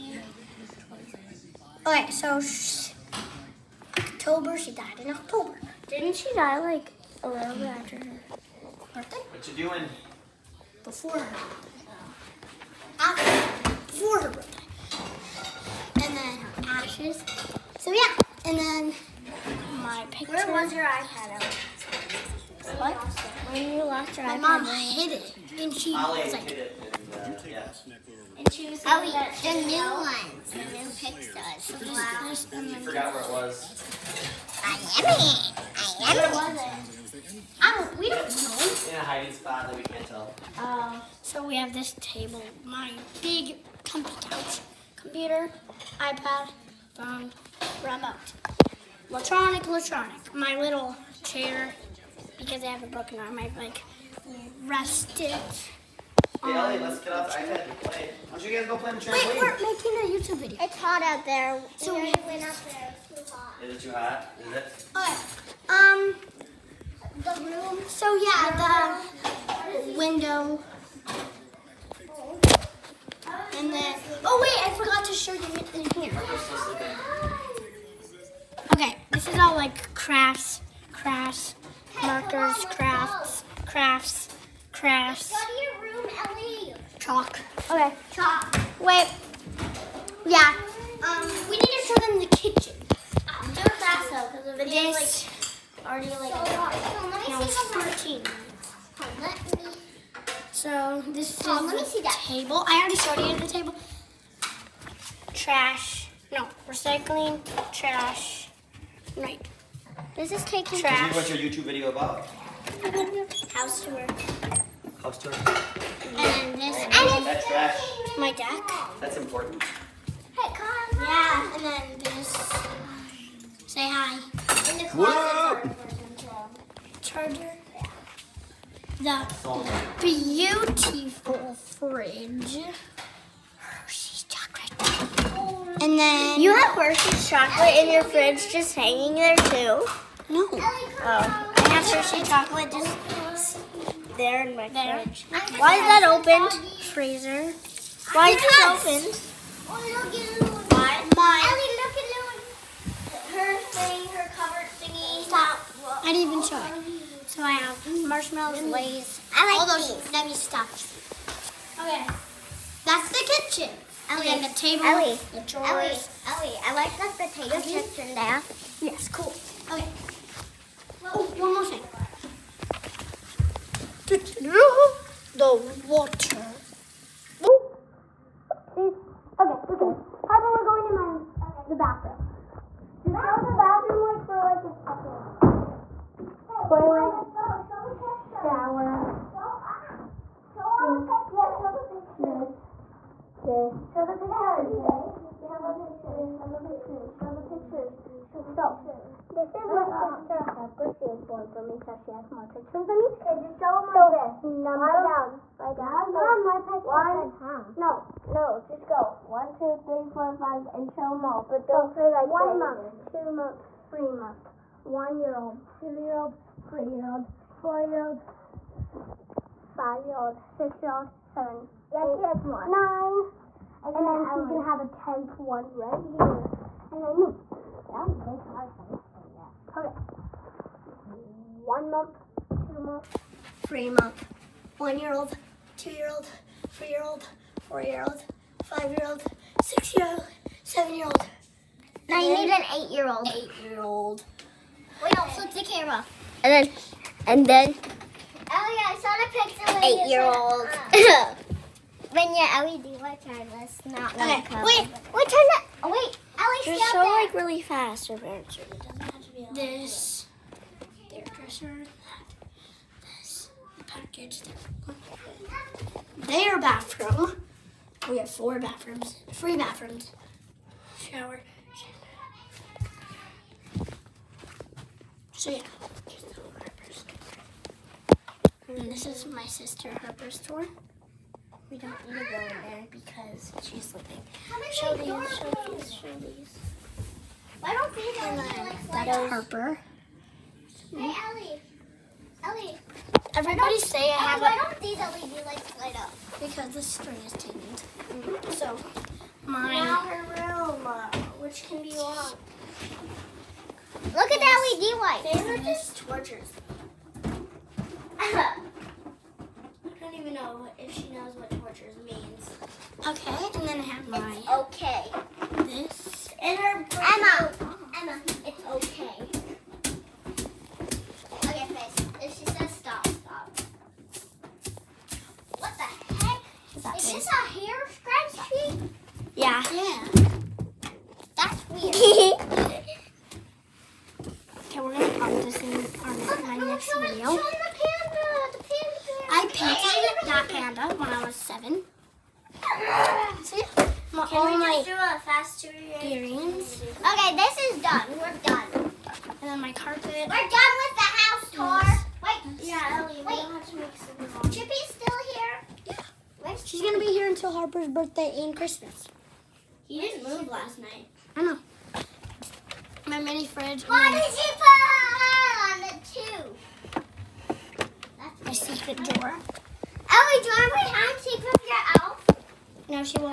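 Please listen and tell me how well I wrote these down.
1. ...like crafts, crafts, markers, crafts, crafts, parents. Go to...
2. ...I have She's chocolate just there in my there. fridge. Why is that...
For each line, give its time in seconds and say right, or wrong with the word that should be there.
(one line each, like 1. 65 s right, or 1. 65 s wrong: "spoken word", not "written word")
1. 79 s wrong: "crafts", not "parents"
2. 141 s wrong: "Hershey", not "She".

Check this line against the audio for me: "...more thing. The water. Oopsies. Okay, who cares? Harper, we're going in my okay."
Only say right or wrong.
right.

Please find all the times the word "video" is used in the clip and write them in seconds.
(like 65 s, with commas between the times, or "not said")
60 s, 94 s, 111 s.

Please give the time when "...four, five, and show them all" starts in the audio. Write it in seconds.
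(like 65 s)
210 s.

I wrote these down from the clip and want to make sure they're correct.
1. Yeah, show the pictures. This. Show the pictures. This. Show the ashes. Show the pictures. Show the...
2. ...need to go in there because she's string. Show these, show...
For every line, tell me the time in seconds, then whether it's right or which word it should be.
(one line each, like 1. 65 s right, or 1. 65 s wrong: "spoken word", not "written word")
1. 191 s wrong: "pictures", not "ashes"
2. 282 s wrong: "sleeping", not "string".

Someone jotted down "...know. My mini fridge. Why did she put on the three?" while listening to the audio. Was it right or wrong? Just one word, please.
wrong.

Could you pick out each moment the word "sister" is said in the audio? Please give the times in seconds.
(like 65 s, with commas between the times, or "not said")
199 s, 279 s.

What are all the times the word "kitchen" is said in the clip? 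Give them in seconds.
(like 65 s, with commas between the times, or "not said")
92 s, 163 s.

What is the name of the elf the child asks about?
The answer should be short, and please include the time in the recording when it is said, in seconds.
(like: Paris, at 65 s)
Chippy, at 354 s.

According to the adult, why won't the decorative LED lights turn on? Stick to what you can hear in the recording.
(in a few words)
The string is tangled.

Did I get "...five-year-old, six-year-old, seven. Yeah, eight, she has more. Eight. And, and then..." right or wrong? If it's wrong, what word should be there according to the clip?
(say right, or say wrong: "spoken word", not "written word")
wrong: "Nine", not "Eight".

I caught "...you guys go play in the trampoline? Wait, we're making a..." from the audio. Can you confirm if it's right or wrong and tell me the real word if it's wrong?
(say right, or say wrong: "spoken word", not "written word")
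right.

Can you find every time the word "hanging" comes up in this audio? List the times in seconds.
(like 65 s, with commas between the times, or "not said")
138 s.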